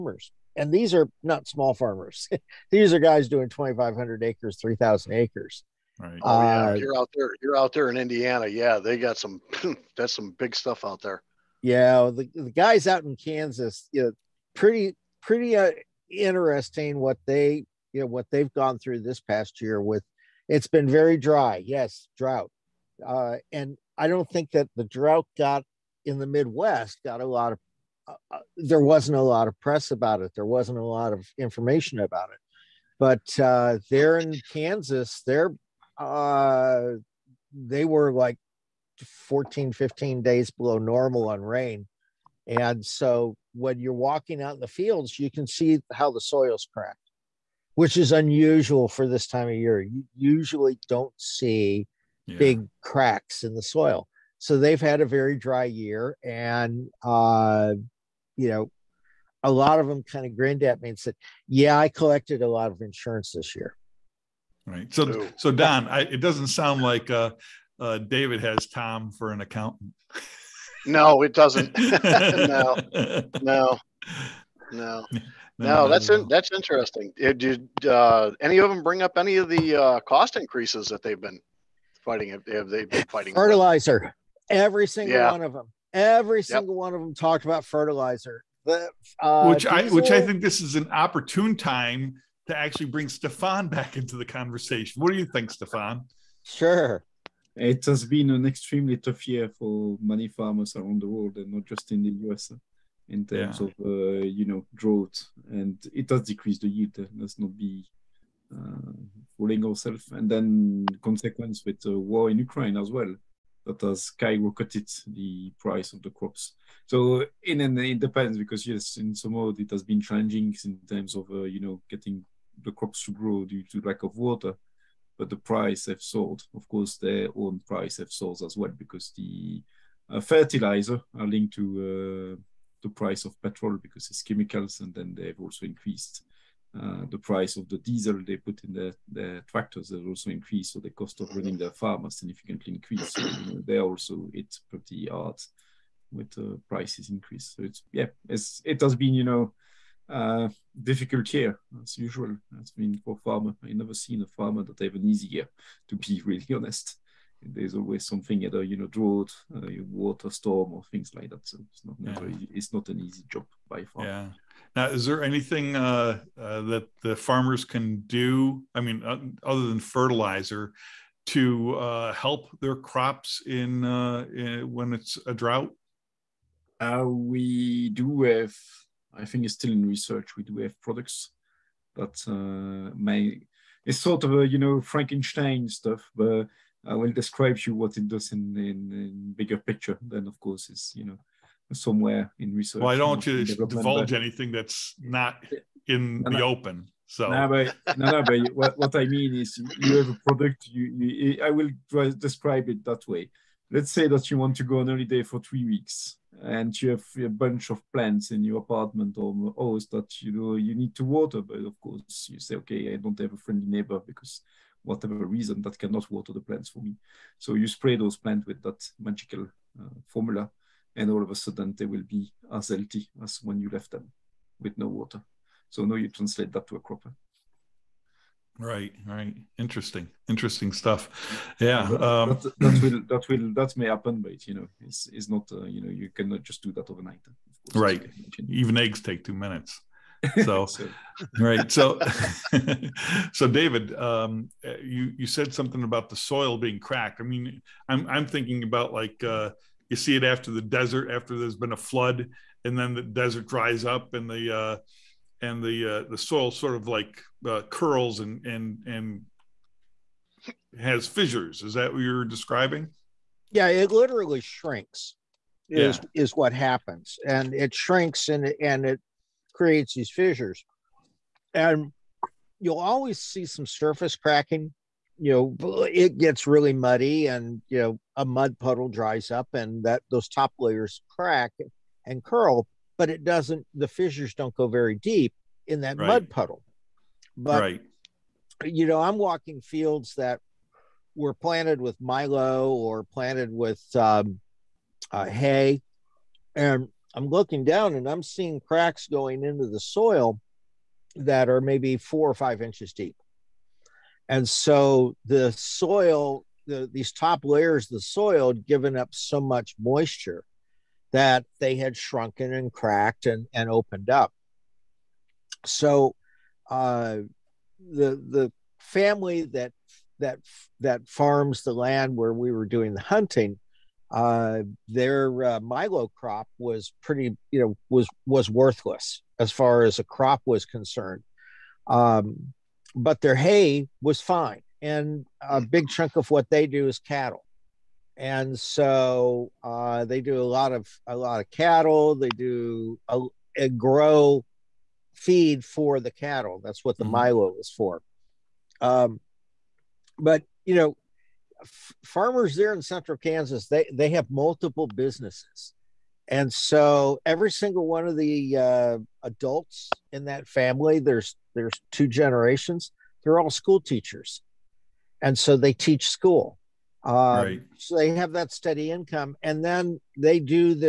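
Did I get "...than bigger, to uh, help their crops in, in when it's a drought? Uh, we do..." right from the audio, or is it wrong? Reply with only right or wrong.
wrong.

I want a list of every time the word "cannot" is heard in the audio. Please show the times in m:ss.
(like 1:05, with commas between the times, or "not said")
3:35, 3:56.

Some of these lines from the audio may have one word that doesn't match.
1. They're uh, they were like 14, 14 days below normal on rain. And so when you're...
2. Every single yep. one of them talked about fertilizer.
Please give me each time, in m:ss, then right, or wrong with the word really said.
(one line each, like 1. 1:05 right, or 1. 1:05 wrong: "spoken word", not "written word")
1. 0:35 wrong: "15", not "14"
2. 1:25 right.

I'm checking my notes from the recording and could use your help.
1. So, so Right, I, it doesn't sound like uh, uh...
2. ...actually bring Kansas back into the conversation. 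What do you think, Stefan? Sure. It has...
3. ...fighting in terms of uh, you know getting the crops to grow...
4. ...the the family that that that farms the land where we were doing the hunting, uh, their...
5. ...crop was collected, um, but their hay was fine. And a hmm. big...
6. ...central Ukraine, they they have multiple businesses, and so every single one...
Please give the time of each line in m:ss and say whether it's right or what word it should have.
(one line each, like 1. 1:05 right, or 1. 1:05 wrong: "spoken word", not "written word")
1. 1:04 wrong: "Don", not "Right"
2. 1:32 wrong: "Stefan", not "Kansas"
3. 1:59 wrong: "challenging", not "fighting"
4. 5:17 right
5. 5:30 wrong: "concerned", not "collected"
6. 5:52 wrong: "Kansas", not "Ukraine".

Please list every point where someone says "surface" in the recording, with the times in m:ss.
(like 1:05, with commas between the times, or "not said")
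4:33.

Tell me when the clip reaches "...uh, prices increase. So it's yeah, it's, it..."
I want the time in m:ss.
2:26.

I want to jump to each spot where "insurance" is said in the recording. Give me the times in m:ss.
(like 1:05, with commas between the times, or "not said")
1:02.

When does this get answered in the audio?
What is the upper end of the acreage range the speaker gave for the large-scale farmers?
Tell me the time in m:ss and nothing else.
0:04.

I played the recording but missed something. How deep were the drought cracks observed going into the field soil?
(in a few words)
4 or 5 inches.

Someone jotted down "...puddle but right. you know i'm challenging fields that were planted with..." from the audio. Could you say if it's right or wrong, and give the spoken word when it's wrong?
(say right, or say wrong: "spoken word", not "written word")
wrong: "walking", not "challenging".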